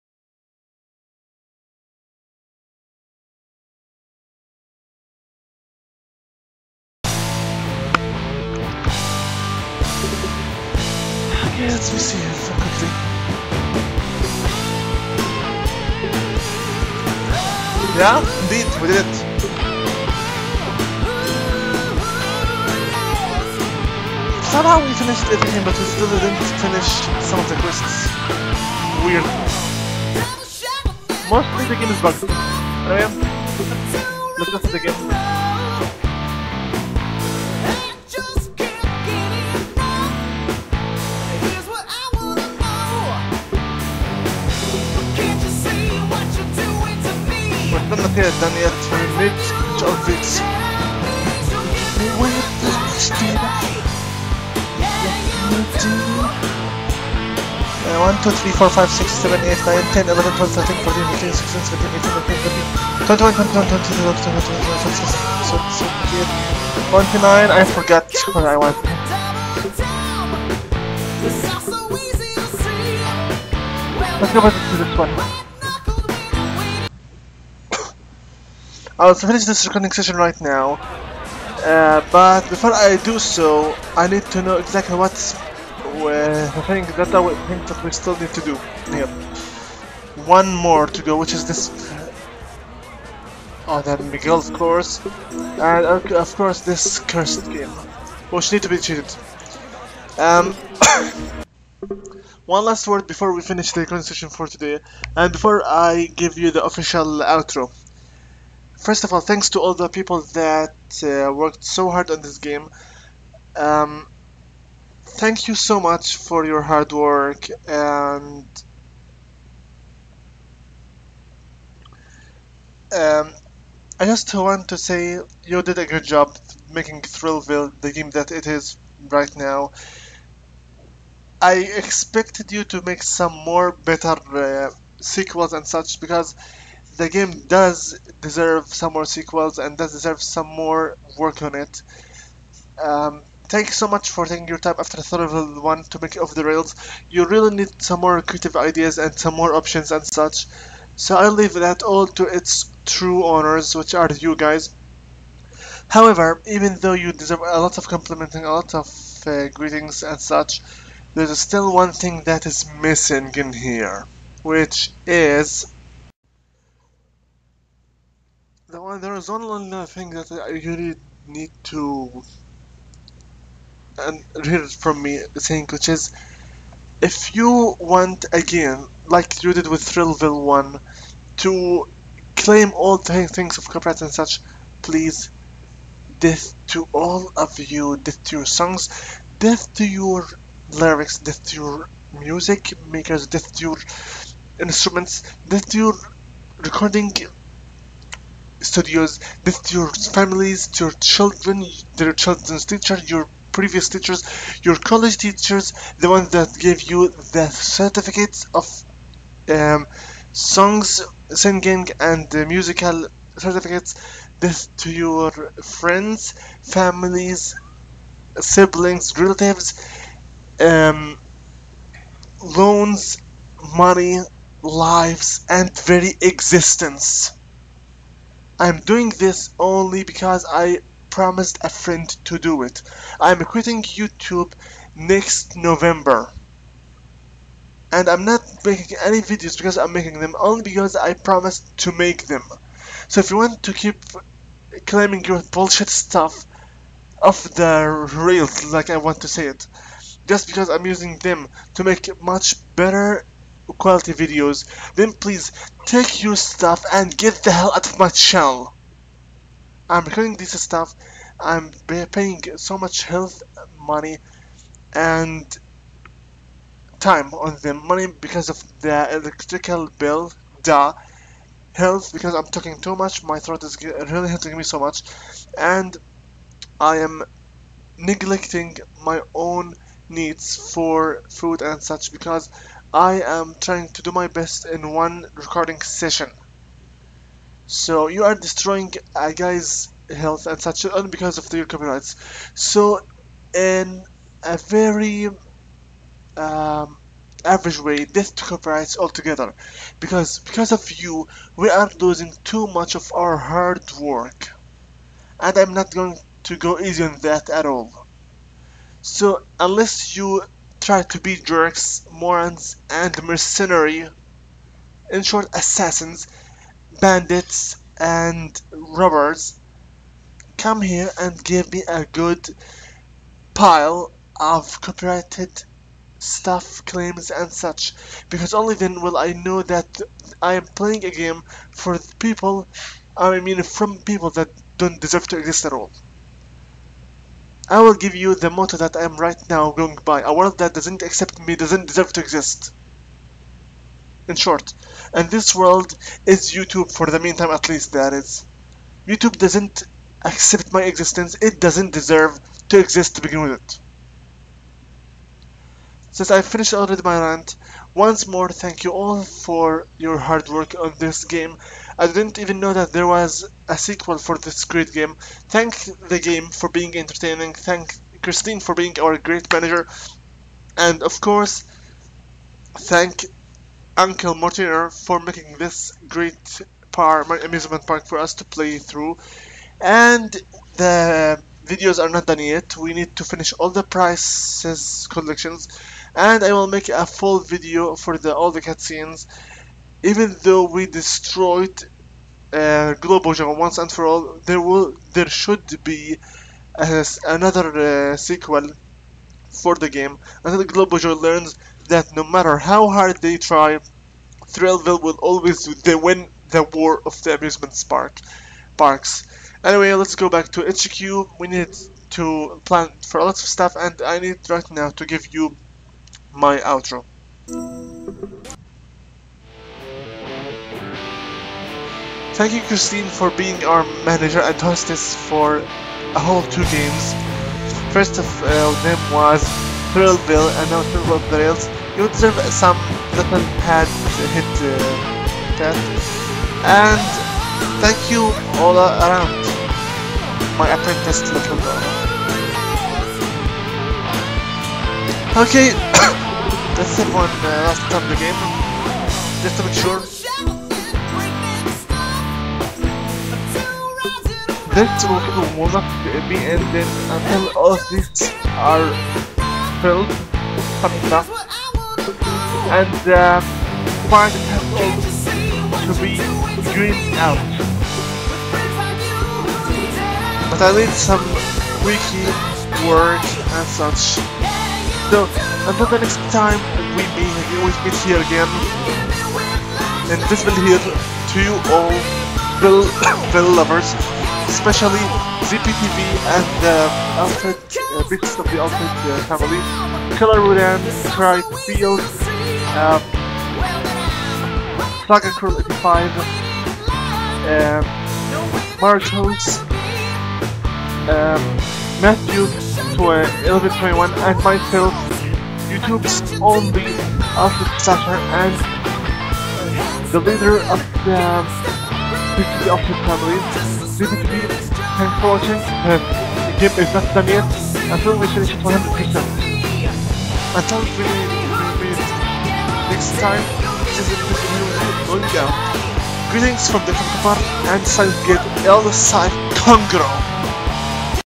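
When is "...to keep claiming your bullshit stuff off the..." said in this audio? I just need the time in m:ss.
4:03.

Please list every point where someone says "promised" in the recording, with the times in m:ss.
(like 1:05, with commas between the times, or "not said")
3:51, 4:01.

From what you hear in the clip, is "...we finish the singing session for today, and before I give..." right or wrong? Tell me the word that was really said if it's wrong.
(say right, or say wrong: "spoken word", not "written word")
wrong: "recording", not "singing".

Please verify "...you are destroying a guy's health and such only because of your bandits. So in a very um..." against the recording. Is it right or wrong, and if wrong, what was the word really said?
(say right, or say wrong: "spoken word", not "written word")
wrong: "copyrights", not "bandits".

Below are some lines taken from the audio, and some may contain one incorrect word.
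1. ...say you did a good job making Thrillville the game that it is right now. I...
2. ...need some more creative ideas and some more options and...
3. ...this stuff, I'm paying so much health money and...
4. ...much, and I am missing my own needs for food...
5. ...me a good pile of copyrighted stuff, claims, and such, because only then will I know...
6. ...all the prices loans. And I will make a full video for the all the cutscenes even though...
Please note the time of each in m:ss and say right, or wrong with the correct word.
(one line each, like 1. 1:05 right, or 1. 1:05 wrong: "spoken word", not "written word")
1. 2:04 right
2. 2:27 right
3. 4:20 right
4. 4:34 wrong: "neglecting", not "missing"
5. 5:21 right
6. 6:23 wrong: "collections", not "loans".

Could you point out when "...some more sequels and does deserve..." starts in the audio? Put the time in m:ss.
2:18.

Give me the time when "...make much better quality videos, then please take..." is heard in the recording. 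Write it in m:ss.
4:11.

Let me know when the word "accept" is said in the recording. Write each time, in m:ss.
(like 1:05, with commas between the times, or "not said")
5:41, 5:50.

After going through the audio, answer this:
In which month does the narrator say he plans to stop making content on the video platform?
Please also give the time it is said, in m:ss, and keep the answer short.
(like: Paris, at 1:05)
November, at 3:55.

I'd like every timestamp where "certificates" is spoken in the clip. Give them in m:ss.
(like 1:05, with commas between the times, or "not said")
3:27, 3:33.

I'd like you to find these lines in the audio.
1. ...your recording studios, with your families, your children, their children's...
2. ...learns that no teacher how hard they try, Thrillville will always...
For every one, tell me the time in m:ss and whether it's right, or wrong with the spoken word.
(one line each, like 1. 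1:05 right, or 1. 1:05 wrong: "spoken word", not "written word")
1. 3:15 right
2. 6:41 wrong: "matter", not "teacher".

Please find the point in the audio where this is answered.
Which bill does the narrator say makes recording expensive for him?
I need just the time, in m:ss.
4:29.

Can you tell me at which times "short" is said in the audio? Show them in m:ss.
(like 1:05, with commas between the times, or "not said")
5:15, 5:44.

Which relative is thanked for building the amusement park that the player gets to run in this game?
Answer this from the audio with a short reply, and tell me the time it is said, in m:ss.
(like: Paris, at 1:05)
Uncle Mortimer, at 6:13.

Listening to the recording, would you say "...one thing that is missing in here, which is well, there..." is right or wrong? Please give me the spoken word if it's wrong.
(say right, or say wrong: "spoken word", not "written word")
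right.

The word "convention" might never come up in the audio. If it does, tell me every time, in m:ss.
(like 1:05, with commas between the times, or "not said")
not said.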